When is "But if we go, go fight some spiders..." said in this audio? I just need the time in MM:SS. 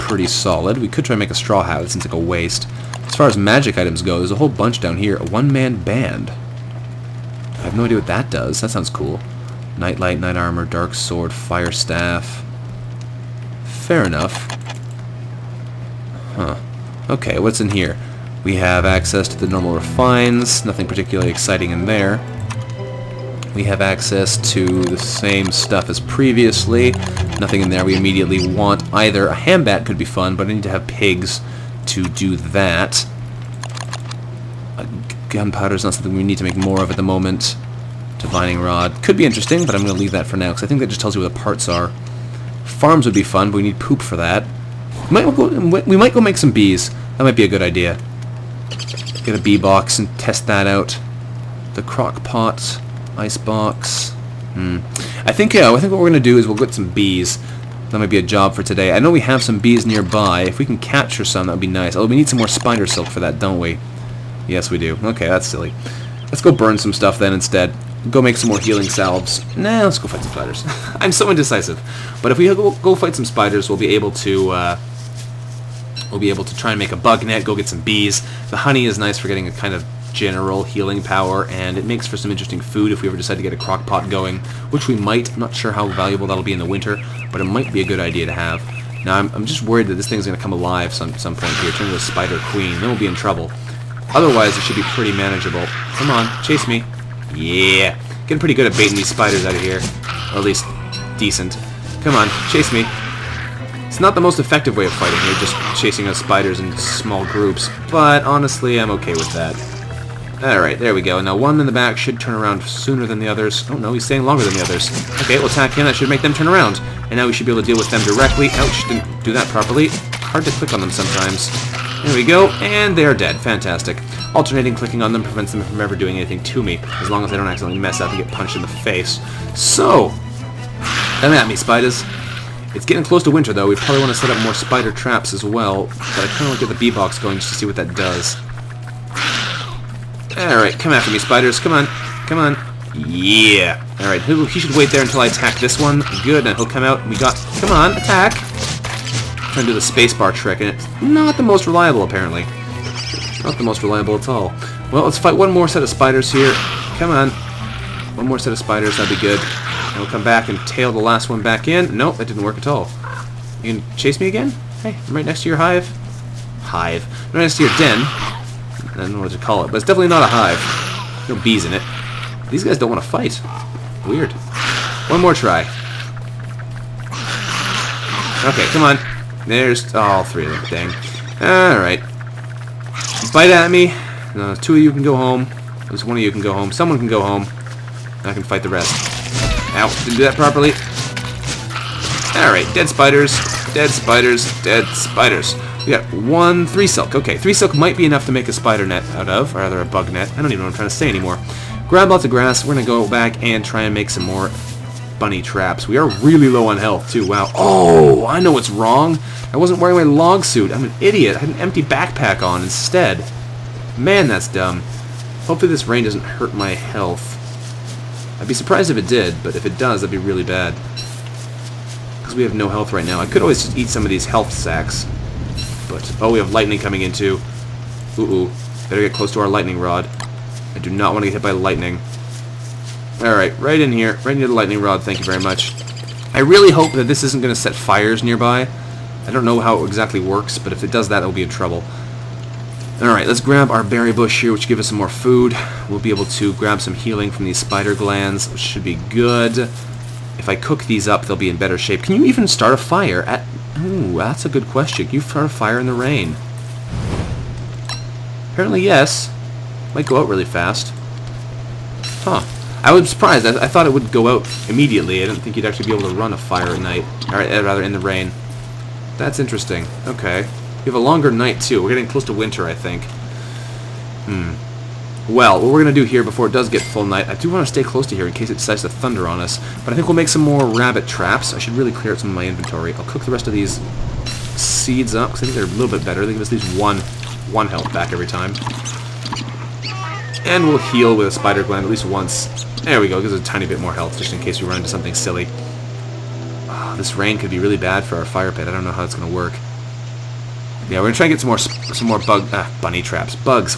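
01:12.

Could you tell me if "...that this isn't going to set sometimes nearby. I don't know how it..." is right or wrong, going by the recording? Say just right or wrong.
wrong.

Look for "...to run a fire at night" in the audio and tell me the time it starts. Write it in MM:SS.
04:26.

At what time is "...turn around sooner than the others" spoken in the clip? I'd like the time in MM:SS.
01:52.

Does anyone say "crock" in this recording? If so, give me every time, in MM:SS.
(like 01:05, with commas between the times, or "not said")
00:51, 01:23.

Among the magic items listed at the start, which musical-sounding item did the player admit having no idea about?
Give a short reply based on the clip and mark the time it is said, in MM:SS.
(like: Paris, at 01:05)
One-man band, at 00:05.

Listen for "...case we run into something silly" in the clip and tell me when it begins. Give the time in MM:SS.
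04:54.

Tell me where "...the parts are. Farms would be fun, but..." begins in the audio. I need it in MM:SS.
00:41.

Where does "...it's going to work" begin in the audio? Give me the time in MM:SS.
04:59.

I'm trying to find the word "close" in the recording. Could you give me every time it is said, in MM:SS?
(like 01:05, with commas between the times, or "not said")
02:13, 03:49, 04:32, 04:37.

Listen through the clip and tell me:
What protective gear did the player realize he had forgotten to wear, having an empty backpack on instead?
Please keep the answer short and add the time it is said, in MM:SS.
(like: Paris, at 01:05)
Log suit, at 03:30.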